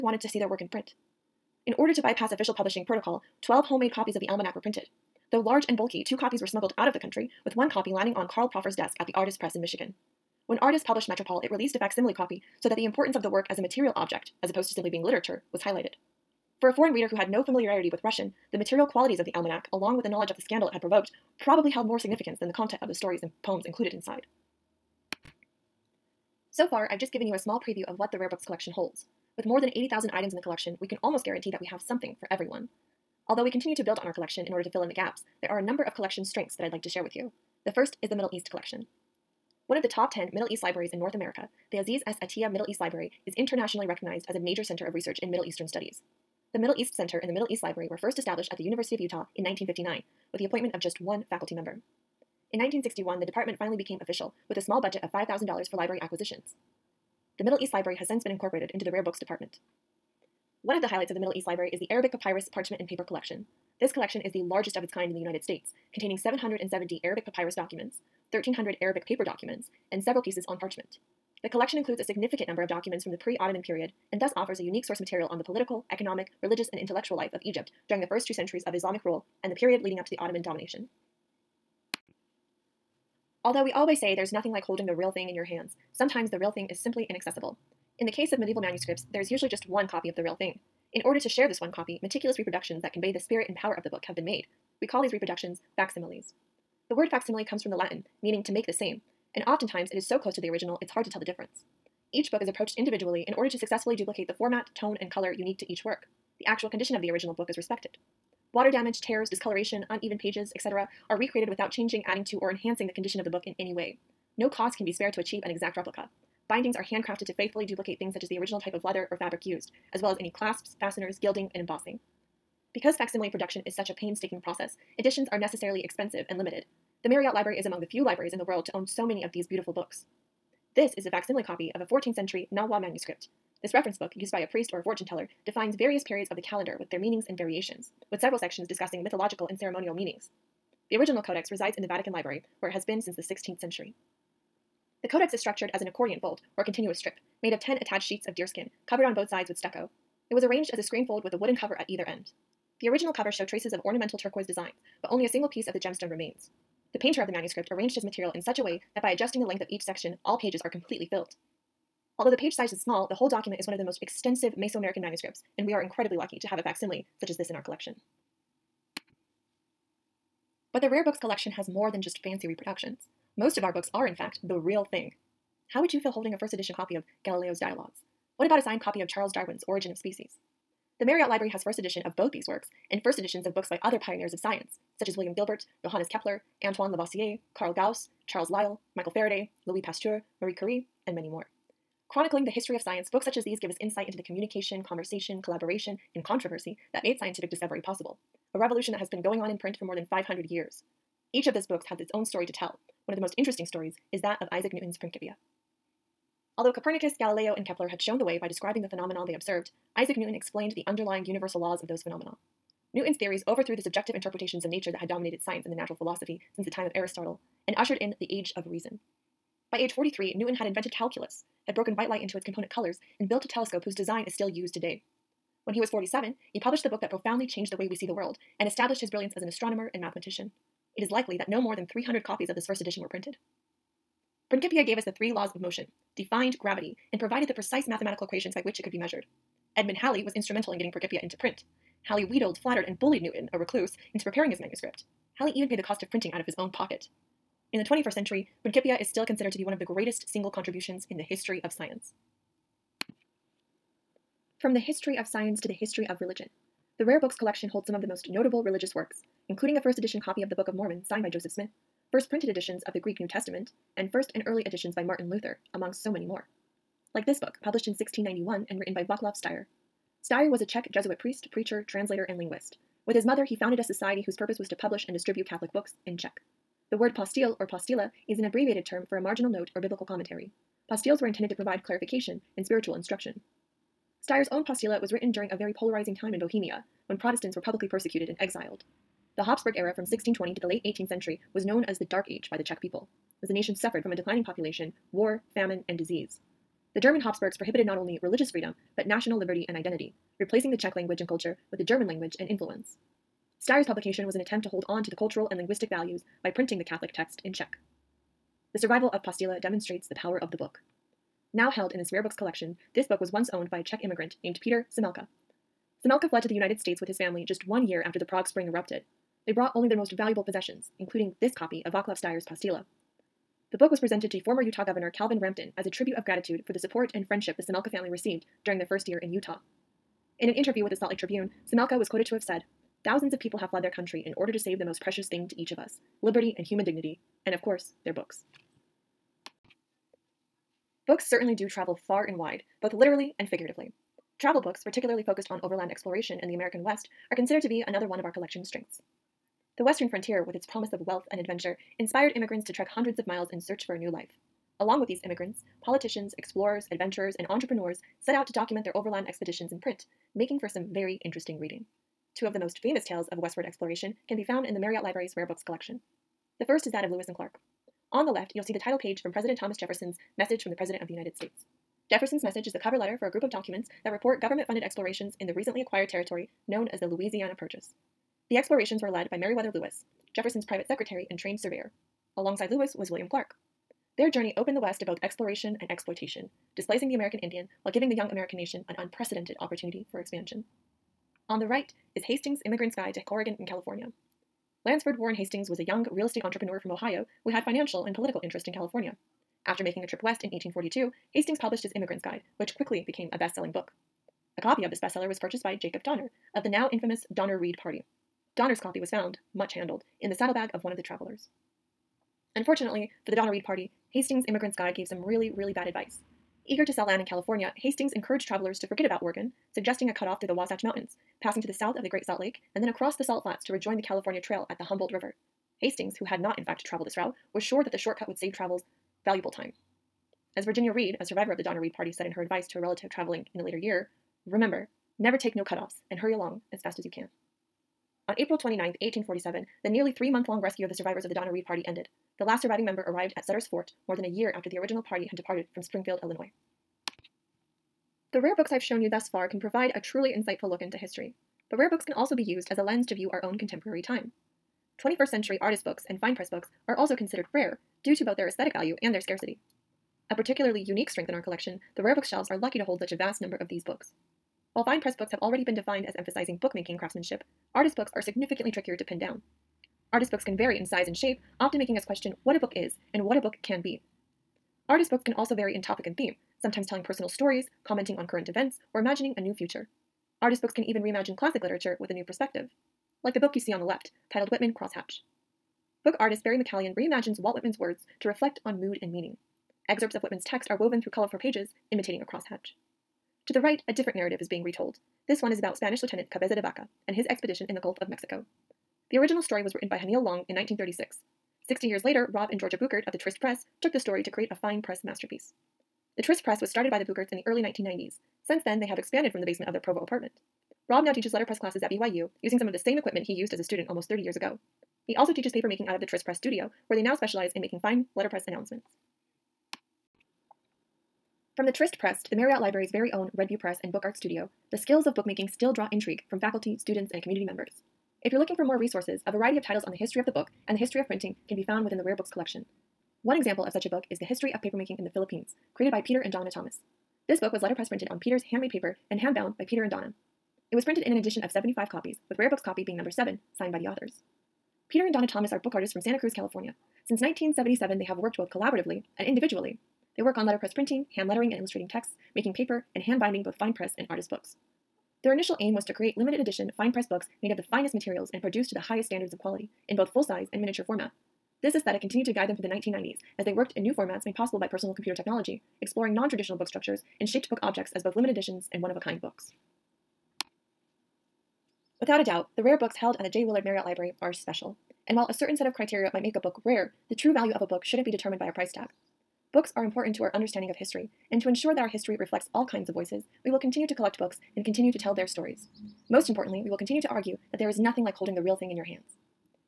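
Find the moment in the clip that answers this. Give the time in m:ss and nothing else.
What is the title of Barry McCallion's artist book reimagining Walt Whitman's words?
8:04.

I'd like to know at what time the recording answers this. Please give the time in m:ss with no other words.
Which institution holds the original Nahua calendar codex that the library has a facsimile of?
2:21.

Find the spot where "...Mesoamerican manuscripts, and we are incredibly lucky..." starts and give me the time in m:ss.
2:44.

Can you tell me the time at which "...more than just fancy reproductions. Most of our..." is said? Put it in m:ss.
2:51.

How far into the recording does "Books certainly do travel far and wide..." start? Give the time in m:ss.
5:41.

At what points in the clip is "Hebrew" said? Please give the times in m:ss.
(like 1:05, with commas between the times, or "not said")
not said.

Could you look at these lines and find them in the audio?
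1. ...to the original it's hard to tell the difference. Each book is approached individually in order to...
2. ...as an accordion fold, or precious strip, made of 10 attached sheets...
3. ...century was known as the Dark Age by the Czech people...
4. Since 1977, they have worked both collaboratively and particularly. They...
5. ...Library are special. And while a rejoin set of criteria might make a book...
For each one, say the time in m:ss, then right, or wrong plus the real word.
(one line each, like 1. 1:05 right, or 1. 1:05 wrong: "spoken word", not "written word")
1. 1:40 right
2. 2:25 wrong: "continuous", not "precious"
3. 4:51 right
4. 9:07 wrong: "individually", not "particularly"
5. 9:33 wrong: "certain", not "rejoin".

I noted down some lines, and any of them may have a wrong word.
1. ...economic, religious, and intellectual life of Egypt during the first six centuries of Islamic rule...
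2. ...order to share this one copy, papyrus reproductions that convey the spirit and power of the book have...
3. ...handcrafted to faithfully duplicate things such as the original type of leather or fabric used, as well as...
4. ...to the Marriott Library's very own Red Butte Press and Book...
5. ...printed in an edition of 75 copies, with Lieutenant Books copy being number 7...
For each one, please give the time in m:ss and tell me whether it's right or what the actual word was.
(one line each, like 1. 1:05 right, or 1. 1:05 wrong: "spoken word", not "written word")
1. 1:15 wrong: "two", not "six"
2. 1:31 wrong: "meticulous", not "papyrus"
3. 1:56 right
4. 8:42 right
5. 9:00 wrong: "Rare", not "Lieutenant".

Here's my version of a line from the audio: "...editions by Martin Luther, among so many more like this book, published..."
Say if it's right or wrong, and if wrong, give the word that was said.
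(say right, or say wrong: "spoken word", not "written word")
right.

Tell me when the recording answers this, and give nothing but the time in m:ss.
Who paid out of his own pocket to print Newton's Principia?
3:59.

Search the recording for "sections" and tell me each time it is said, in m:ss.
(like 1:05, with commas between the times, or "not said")
2:18, 2:39.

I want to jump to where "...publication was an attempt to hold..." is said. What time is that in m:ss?
5:03.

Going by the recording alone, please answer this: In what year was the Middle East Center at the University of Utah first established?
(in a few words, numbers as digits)
1959.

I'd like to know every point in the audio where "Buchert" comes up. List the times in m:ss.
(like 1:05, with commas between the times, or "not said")
8:22, 8:27.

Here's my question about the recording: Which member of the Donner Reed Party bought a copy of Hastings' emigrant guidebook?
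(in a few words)
Jacob Donner.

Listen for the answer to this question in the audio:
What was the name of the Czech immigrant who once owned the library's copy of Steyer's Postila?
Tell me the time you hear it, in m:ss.
5:14.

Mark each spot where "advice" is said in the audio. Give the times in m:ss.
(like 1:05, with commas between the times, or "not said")
6:55, 7:12.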